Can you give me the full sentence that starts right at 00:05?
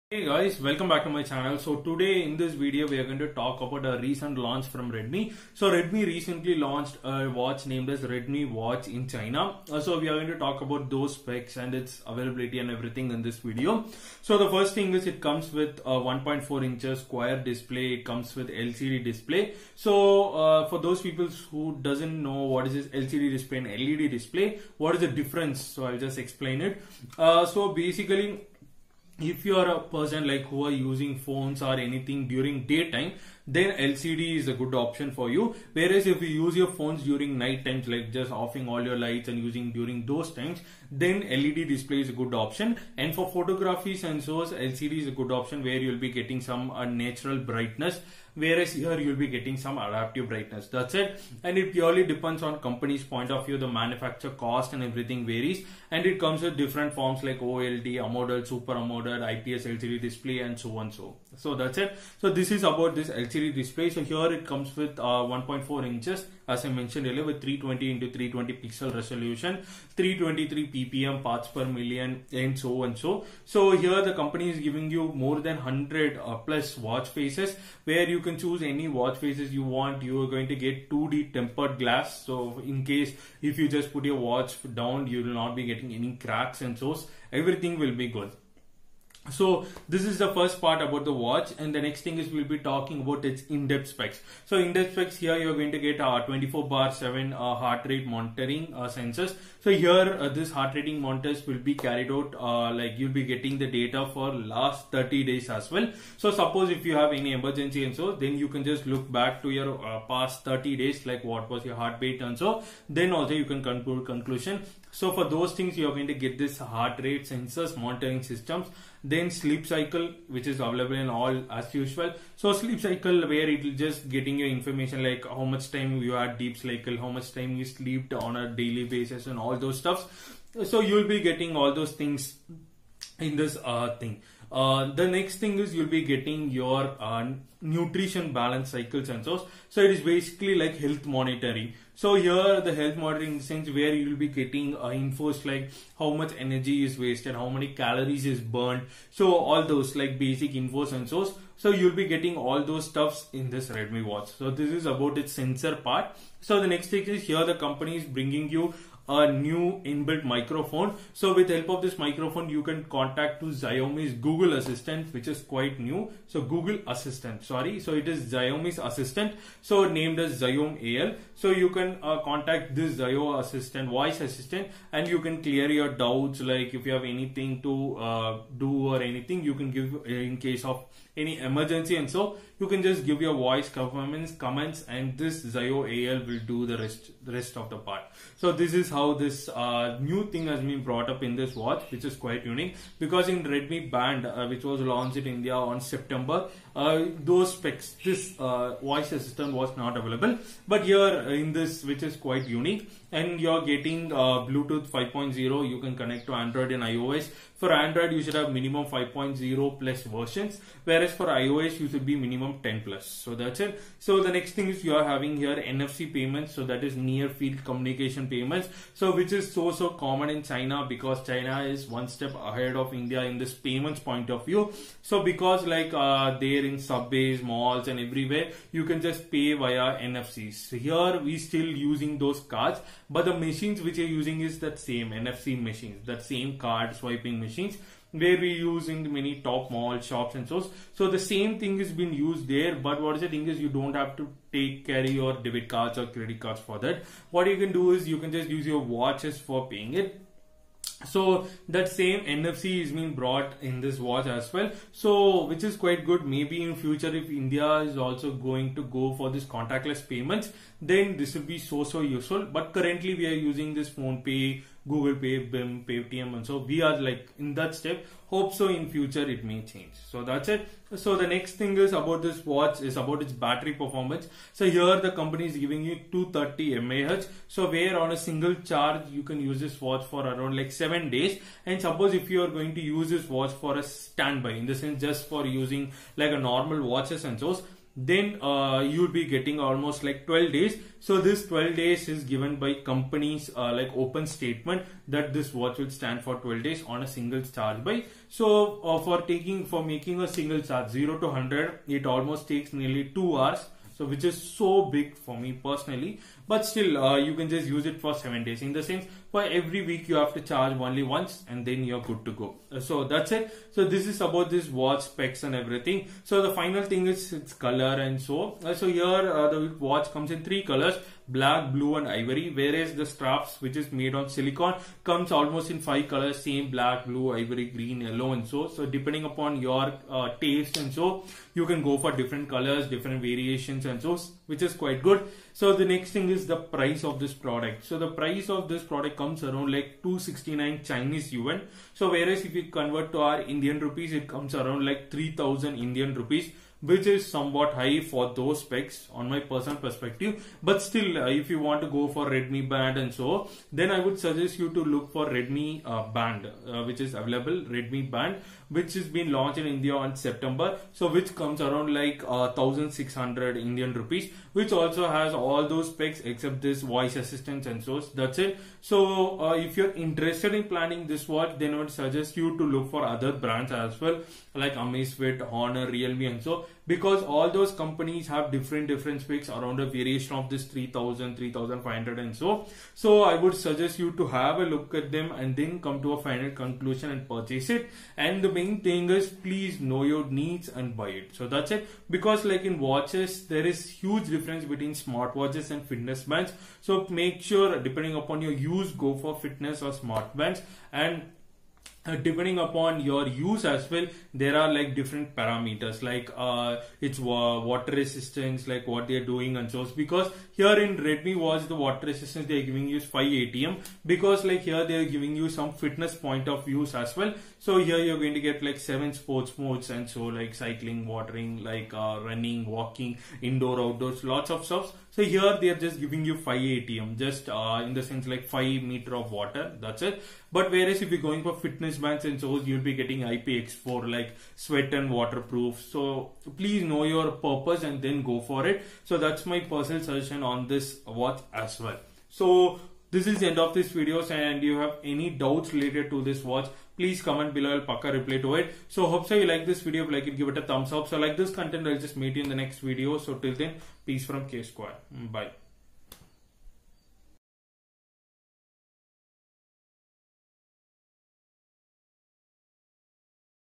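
So Redmi recently launched a watch named as Redmi Watch in China.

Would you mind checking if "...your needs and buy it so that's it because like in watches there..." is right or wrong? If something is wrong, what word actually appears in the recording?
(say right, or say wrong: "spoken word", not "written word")
right.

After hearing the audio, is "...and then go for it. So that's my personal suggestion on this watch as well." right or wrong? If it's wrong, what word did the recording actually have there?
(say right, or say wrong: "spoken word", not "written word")
right.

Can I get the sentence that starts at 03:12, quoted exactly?
Because in Redmi Band, uh, which was launched in India on September, uh, those specs, this uh, voice assistant was not available.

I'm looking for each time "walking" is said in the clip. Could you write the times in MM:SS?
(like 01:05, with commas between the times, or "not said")
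07:02.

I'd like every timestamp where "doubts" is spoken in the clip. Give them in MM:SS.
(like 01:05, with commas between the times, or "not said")
02:55, 07:25.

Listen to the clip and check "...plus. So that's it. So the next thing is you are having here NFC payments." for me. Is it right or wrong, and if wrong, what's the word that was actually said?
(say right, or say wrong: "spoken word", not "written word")
right.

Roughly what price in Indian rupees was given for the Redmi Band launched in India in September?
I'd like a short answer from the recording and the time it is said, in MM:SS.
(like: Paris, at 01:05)
1600 rupees, at 06:02.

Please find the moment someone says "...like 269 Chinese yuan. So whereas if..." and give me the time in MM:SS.
05:39.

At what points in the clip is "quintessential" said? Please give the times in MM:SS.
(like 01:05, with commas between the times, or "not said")
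not said.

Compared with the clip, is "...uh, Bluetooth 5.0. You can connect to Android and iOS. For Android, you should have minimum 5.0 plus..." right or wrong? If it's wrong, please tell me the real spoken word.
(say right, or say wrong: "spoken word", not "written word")
right.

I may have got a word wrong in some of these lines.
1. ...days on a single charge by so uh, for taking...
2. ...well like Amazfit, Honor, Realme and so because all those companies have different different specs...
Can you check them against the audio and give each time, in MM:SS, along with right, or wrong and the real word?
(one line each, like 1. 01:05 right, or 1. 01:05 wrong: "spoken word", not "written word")
1. 04:56 right
2. 06:13 right.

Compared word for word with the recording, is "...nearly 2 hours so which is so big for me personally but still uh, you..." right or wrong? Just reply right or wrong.
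right.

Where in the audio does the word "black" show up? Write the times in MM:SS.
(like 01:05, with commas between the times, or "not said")
05:21, 05:26.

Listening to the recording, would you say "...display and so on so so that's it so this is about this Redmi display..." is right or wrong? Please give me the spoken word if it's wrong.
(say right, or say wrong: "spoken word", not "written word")
wrong: "LCD", not "Redmi".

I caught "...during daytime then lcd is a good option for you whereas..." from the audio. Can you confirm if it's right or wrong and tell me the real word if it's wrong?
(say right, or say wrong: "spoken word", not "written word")
right.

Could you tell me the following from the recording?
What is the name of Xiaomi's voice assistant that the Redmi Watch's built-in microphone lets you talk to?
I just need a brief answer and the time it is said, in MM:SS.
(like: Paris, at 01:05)
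Xiaomi AI, at 02:50.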